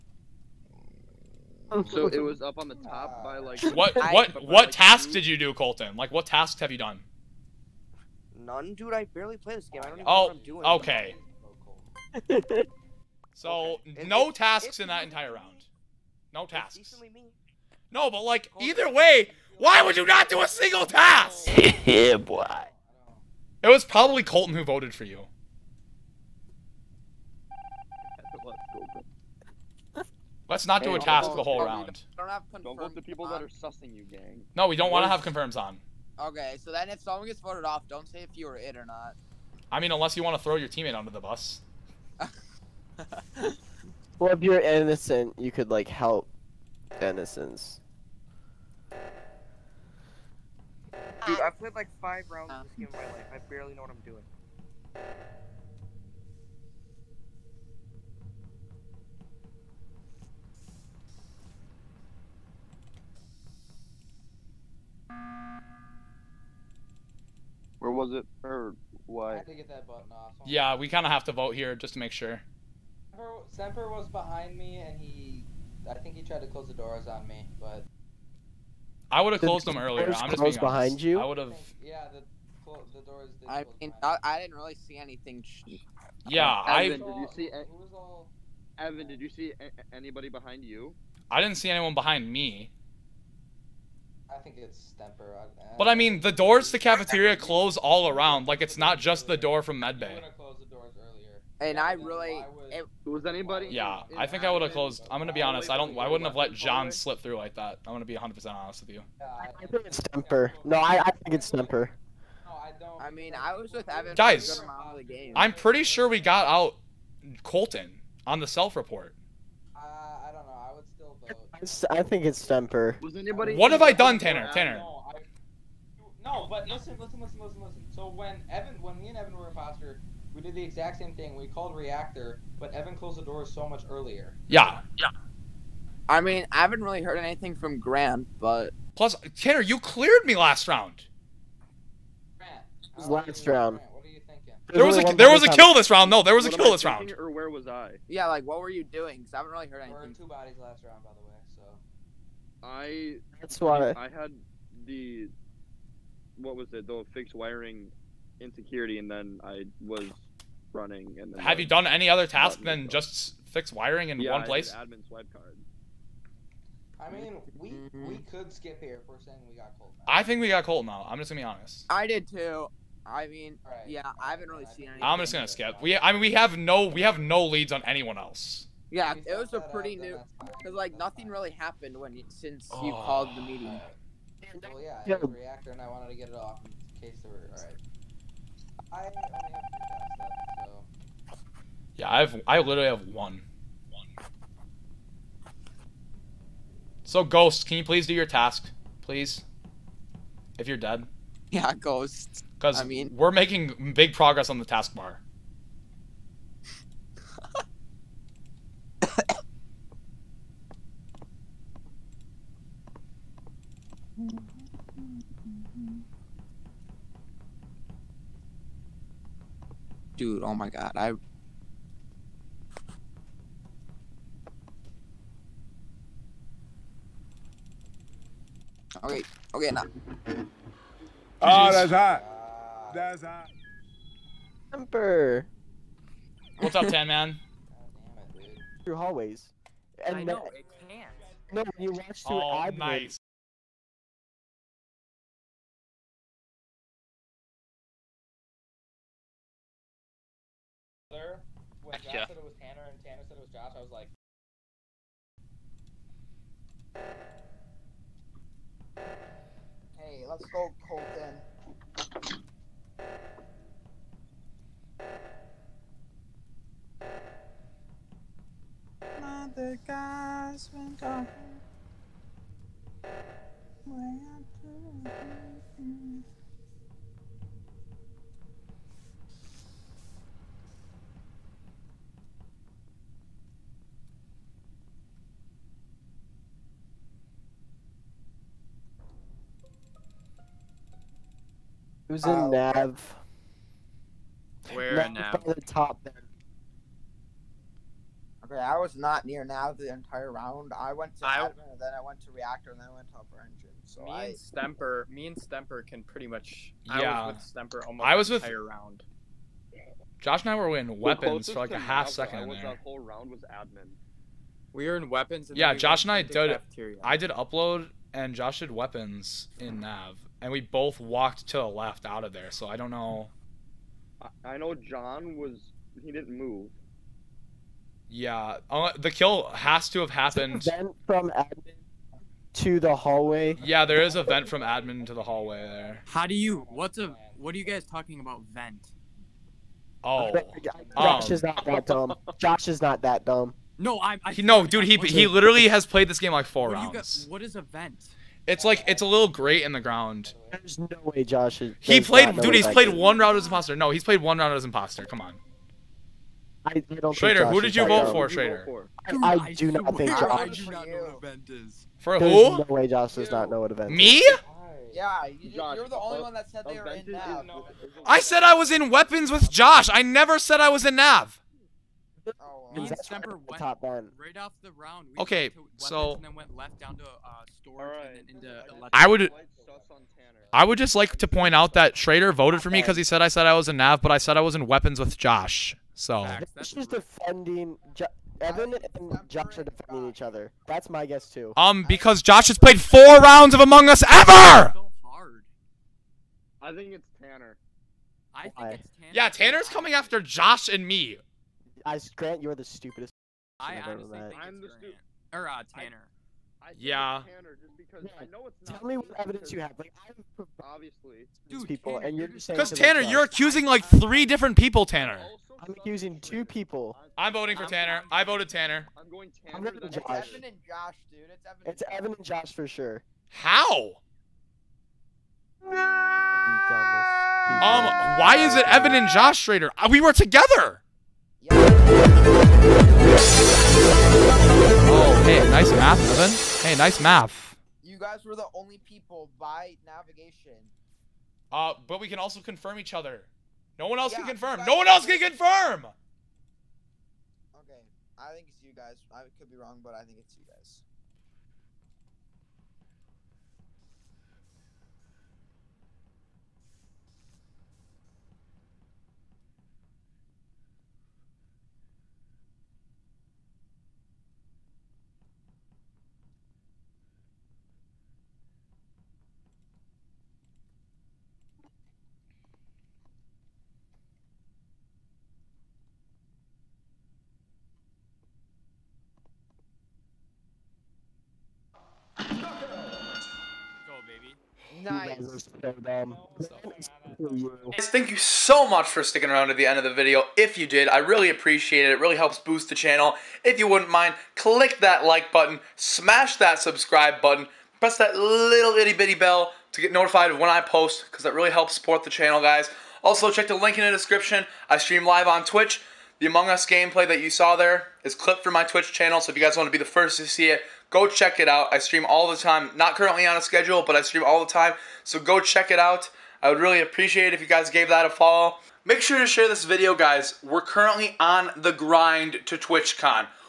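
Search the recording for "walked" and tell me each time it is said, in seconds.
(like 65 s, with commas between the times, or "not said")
321 s.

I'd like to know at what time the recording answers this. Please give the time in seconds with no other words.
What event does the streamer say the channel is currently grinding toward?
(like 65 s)
522 s.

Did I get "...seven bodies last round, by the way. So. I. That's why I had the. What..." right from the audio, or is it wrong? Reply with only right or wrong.
wrong.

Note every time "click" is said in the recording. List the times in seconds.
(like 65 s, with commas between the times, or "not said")
494 s.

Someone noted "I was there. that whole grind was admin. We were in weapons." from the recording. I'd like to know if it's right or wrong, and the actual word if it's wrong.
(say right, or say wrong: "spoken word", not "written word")
wrong: "round", not "grind".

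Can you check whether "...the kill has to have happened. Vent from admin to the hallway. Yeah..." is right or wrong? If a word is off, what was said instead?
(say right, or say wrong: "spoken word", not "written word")
right.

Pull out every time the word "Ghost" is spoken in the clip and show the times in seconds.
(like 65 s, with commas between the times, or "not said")
197 s, 201 s.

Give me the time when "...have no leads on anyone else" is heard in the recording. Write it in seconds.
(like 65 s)
177 s.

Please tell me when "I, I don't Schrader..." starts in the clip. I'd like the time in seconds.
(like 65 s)
356 s.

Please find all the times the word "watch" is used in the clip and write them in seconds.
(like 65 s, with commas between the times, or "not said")
241 s.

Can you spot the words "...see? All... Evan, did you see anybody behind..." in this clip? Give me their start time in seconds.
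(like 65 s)
87 s.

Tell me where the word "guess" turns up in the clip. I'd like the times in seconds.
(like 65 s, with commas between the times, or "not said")
391 s.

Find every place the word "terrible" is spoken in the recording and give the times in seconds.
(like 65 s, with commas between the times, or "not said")
not said.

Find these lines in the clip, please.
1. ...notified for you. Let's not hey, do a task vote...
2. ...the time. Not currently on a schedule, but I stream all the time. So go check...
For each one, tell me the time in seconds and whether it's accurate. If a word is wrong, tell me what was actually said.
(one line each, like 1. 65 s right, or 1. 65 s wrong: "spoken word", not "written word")
1. 24 s wrong: "voted", not "notified"
2. 512 s right.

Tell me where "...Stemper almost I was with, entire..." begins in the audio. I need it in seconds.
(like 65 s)
307 s.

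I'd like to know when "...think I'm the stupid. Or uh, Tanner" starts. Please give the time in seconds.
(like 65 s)
404 s.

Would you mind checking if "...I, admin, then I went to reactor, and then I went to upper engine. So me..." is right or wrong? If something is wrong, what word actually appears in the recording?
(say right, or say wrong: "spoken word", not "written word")
right.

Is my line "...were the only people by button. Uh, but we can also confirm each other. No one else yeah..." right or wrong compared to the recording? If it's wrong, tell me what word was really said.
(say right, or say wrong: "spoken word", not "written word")
wrong: "navigation", not "button".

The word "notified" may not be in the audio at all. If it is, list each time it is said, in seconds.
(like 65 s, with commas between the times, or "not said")
499 s.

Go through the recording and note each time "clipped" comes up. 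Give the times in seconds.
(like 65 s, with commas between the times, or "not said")
508 s.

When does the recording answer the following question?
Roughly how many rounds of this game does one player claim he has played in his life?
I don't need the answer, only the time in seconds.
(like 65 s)
52 s.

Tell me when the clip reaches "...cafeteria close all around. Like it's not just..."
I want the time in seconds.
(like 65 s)
96 s.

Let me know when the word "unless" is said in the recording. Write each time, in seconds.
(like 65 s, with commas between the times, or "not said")
39 s.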